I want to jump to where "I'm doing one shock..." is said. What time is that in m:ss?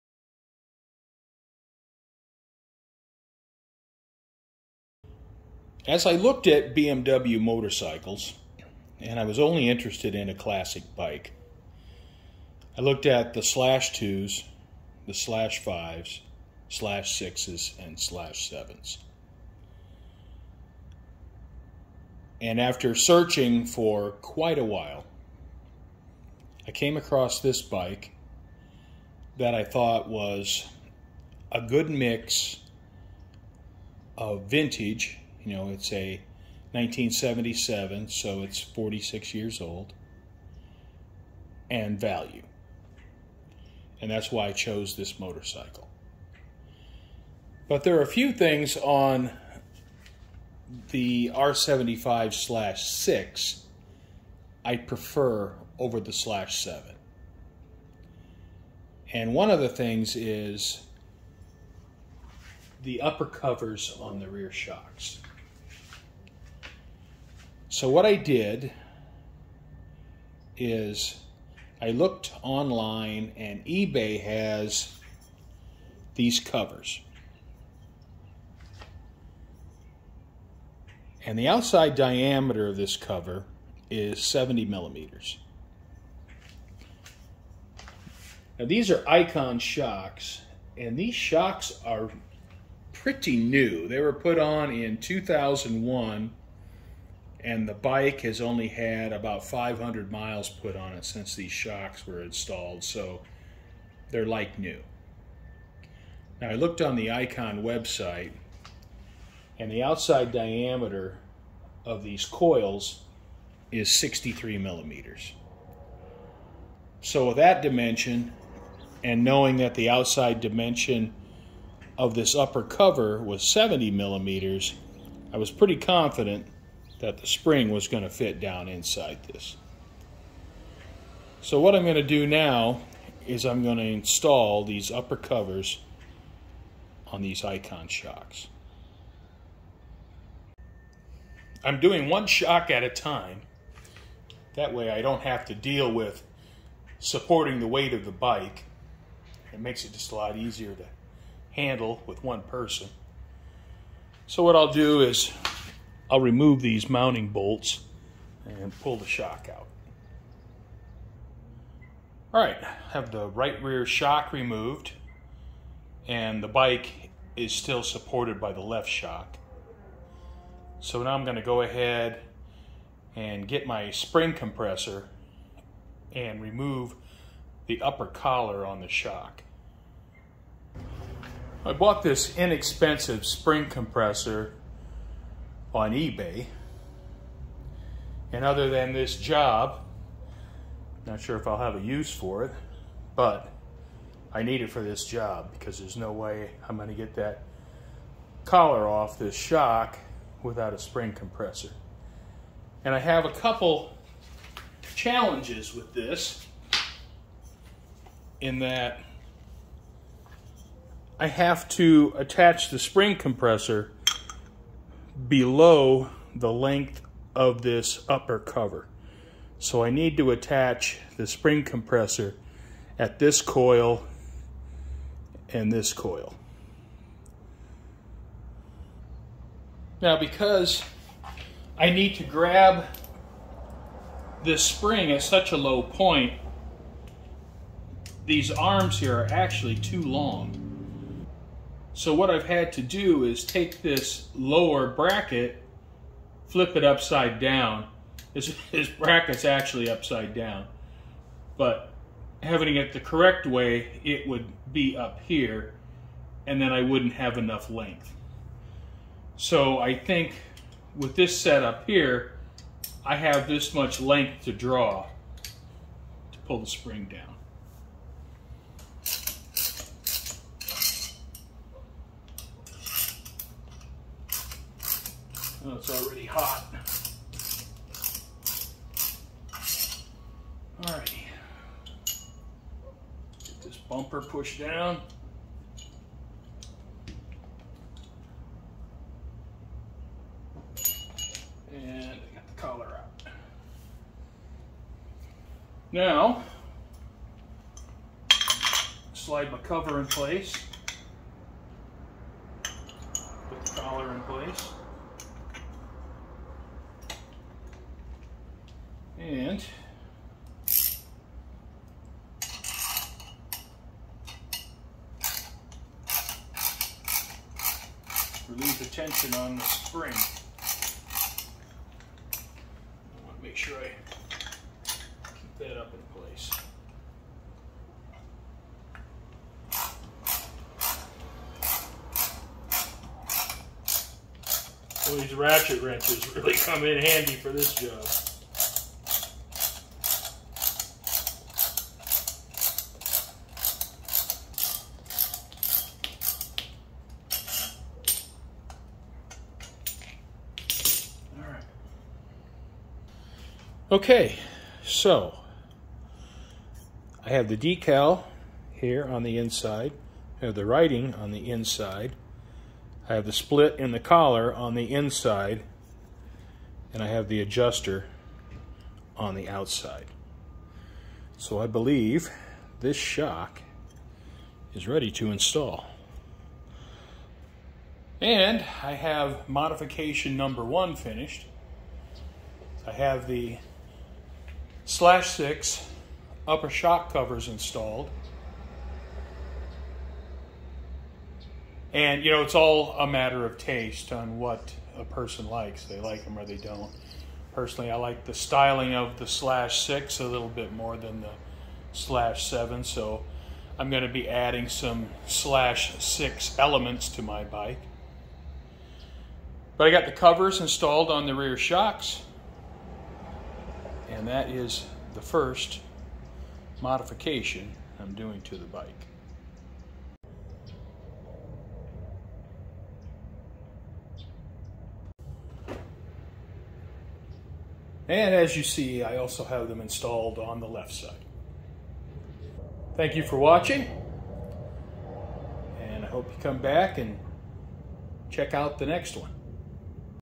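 2:21.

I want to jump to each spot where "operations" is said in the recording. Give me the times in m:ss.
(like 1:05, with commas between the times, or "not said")
not said.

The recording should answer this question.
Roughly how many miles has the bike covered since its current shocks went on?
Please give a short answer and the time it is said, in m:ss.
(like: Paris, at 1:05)
500 miles, at 1:39.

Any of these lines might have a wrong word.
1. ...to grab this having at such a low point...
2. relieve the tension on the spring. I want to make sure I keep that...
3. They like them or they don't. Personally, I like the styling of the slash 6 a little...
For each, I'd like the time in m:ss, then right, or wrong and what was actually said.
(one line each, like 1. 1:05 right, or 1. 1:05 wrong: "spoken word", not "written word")
1. 3:52 wrong: "spring", not "having"
2. 5:18 right
3. 6:35 right.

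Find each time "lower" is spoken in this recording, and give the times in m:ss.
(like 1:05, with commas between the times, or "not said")
4:04.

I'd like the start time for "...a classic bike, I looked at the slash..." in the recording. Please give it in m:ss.
0:10.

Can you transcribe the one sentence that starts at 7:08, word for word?
And as you see, I also have them installed on the left side.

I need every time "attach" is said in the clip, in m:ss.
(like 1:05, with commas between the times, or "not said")
3:32, 3:40.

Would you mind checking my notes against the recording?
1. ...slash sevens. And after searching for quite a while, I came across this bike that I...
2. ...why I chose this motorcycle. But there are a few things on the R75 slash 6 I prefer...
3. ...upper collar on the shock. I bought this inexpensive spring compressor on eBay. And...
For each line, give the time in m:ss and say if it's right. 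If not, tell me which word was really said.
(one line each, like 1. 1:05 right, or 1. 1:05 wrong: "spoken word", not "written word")
1. 0:17 right
2. 0:44 right
3. 2:57 right.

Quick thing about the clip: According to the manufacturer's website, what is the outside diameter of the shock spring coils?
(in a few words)
63 millimeters.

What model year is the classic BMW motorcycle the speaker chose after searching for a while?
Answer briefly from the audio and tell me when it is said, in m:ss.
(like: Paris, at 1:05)
1977, at 0:36.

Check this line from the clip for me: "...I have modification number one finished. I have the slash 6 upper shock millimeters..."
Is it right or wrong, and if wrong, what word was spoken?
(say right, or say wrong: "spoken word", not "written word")
wrong: "covers", not "millimeters".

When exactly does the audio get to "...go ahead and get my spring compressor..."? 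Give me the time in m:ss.
2:51.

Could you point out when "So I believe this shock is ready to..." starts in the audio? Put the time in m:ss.
6:11.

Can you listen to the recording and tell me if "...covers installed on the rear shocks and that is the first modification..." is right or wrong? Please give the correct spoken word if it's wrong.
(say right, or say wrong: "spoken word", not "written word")
right.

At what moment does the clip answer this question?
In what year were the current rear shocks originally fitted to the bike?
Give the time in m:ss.
1:34.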